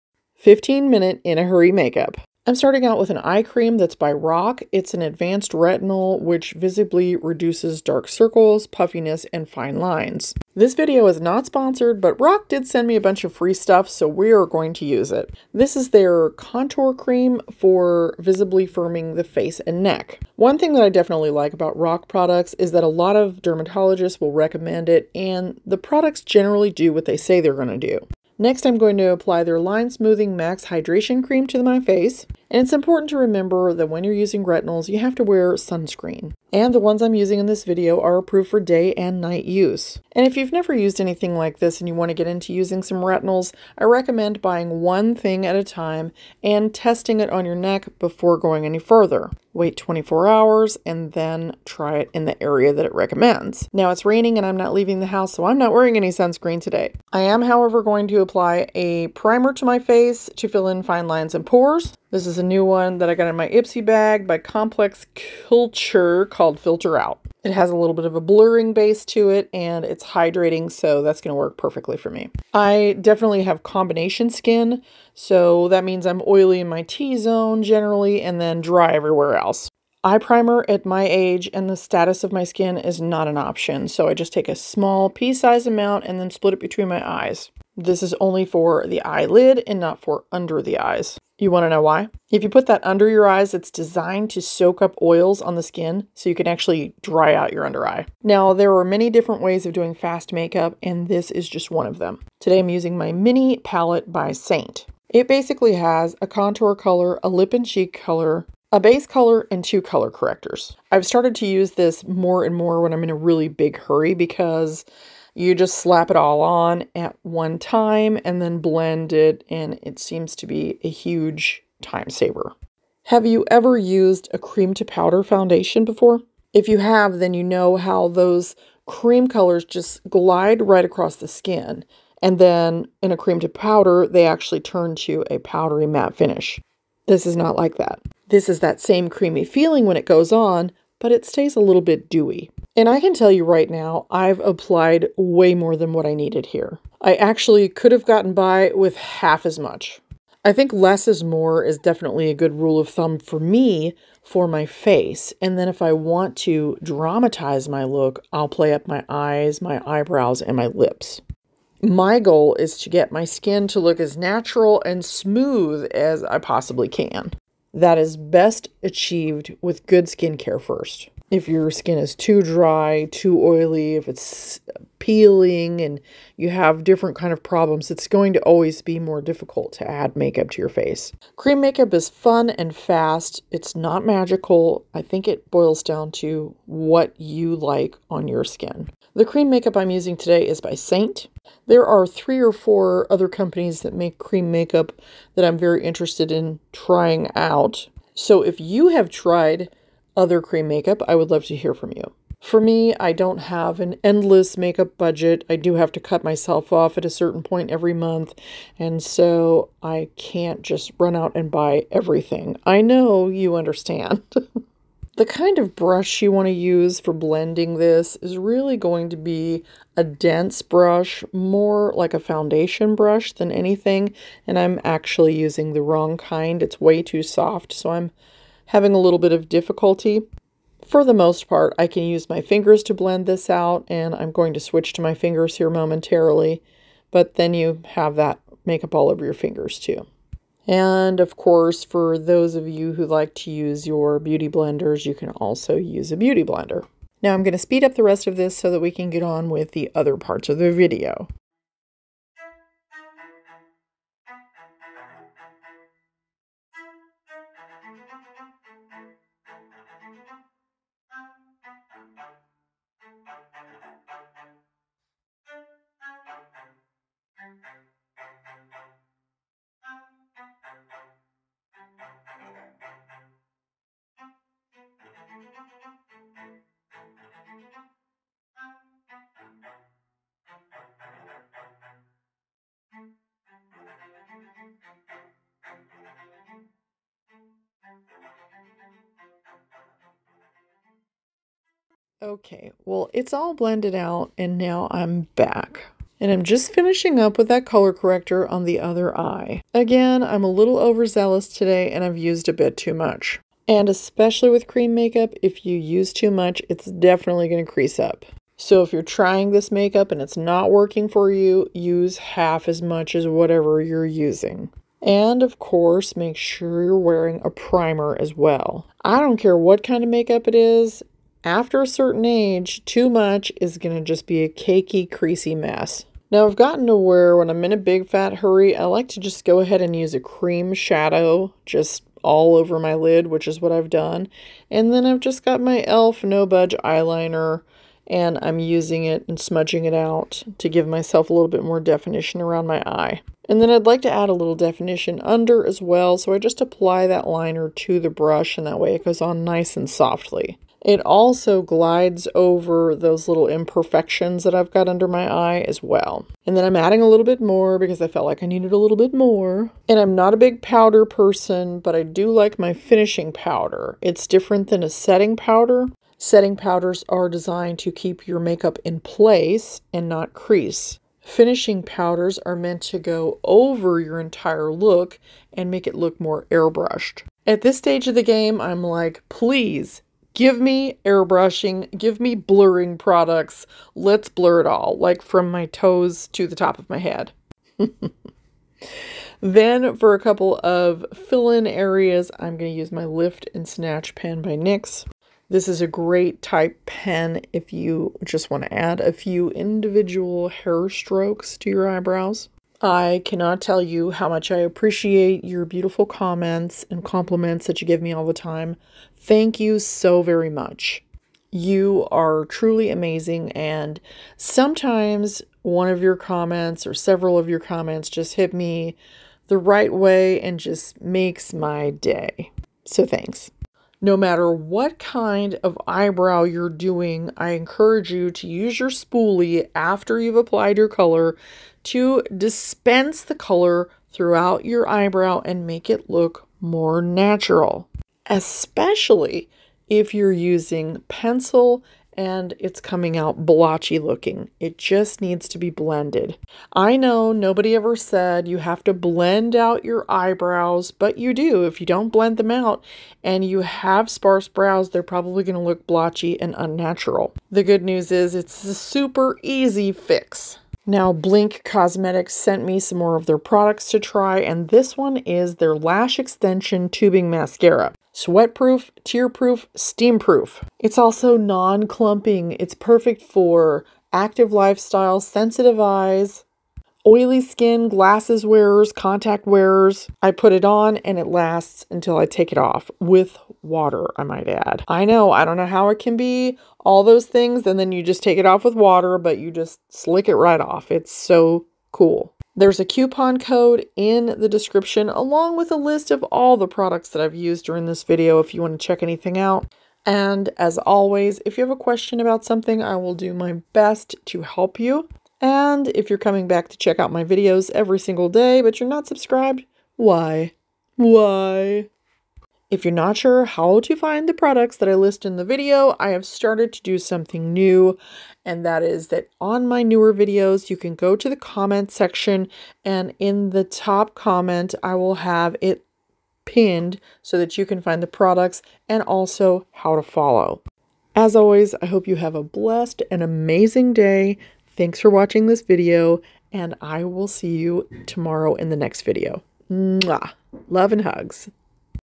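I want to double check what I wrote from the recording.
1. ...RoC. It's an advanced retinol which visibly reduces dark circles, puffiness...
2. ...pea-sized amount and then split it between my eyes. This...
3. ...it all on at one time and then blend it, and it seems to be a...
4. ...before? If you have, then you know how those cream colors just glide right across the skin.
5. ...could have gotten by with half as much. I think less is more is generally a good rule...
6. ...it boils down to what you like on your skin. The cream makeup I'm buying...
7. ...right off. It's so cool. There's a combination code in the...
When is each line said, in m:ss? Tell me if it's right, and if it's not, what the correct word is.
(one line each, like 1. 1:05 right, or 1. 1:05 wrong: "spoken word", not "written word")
1. 0:04 right
2. 1:25 right
3. 1:56 right
4. 2:05 right
5. 2:27 wrong: "definitely", not "generally"
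6. 3:05 wrong: "using", not "buying"
7. 8:10 wrong: "coupon", not "combination".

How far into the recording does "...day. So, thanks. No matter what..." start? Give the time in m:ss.
7:01.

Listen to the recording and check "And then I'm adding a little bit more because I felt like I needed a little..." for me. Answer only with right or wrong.
right.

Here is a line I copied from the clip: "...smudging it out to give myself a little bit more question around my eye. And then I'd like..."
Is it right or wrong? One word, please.
wrong.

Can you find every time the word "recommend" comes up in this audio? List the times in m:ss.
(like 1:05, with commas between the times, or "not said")
0:24, 0:43, 0:52.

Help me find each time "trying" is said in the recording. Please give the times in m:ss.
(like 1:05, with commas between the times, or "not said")
3:16, 5:09.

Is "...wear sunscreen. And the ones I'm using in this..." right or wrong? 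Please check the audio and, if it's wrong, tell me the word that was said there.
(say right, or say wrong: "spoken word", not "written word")
right.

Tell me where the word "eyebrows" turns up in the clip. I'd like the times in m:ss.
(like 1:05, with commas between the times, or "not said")
2:39, 6:41, 7:05, 7:14, 7:30.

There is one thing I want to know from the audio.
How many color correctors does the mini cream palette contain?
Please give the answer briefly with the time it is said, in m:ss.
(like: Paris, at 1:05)
2, at 1:49.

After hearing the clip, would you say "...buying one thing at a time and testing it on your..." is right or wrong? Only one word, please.
right.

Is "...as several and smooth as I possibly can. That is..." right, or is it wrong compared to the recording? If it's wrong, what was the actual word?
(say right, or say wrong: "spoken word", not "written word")
wrong: "natural", not "several".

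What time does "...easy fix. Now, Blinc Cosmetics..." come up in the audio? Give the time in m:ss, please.
7:39.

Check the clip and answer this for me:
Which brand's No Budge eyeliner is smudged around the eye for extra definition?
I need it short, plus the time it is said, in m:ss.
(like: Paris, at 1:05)
e.l.f., at 5:35.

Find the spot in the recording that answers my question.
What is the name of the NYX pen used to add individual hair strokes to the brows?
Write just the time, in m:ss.
6:33.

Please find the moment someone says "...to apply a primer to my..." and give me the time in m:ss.
0:58.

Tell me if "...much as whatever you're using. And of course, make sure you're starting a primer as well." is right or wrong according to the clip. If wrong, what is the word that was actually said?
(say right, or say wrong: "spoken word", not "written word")
wrong: "wearing", not "starting".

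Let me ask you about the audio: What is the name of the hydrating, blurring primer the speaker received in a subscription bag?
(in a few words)
Filter Out.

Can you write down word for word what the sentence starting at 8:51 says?
As always, I hope you have a blessed and amazing day.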